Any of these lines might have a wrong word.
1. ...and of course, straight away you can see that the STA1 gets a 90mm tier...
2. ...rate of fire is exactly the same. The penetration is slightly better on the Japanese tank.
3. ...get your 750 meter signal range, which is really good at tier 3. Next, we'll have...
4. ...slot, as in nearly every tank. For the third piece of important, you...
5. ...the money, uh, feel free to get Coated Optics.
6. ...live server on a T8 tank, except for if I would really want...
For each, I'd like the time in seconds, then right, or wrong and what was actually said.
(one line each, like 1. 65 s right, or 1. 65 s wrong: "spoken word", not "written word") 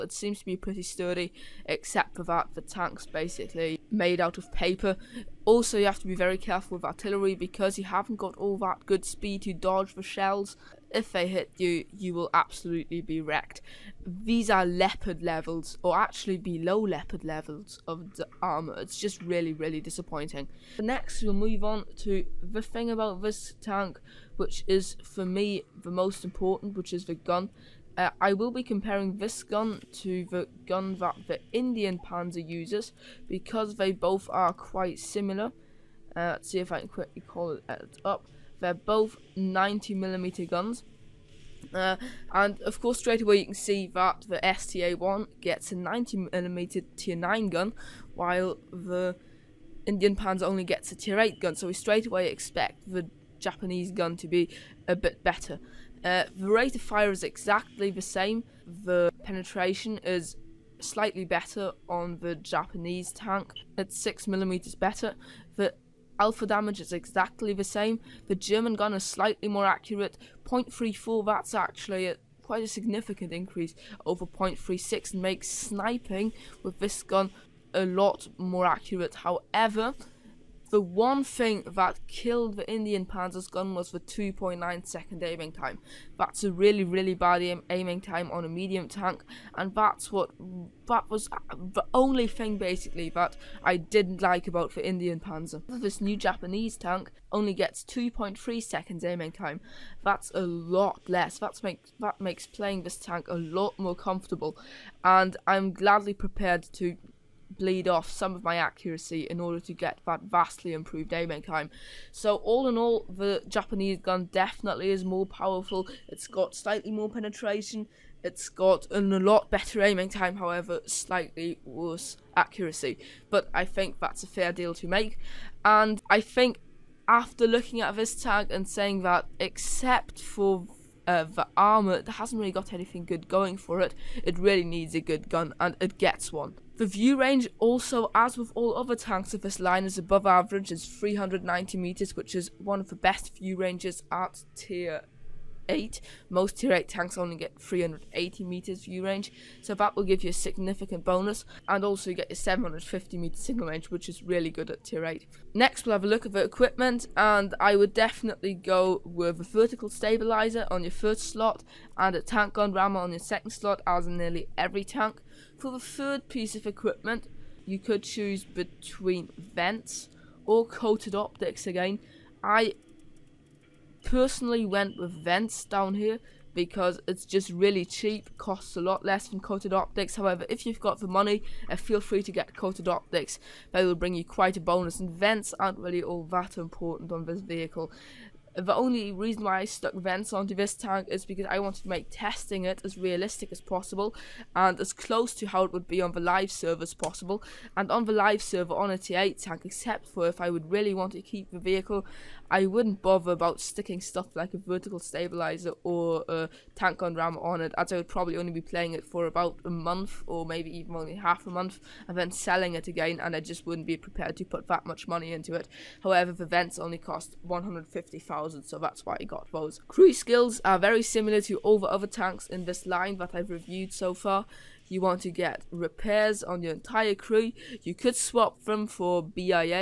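1. 42 s right
2. 56 s right
3. 152 s wrong: "8", not "3"
4. 163 s wrong: "equipment", not "important"
5. 180 s right
6. 198 s right.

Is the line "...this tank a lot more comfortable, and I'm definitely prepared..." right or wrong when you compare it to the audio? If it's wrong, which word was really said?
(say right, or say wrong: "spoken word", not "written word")
wrong: "gladly", not "definitely".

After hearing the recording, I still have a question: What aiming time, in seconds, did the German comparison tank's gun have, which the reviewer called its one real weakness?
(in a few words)
2.9 seconds.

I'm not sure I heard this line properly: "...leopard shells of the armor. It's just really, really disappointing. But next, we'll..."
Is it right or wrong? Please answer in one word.
wrong.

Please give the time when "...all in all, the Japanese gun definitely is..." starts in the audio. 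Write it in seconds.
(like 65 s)
112 s.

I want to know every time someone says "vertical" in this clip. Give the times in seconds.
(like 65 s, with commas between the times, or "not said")
159 s, 204 s.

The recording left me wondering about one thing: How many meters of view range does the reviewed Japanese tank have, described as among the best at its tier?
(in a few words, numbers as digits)
390 meters.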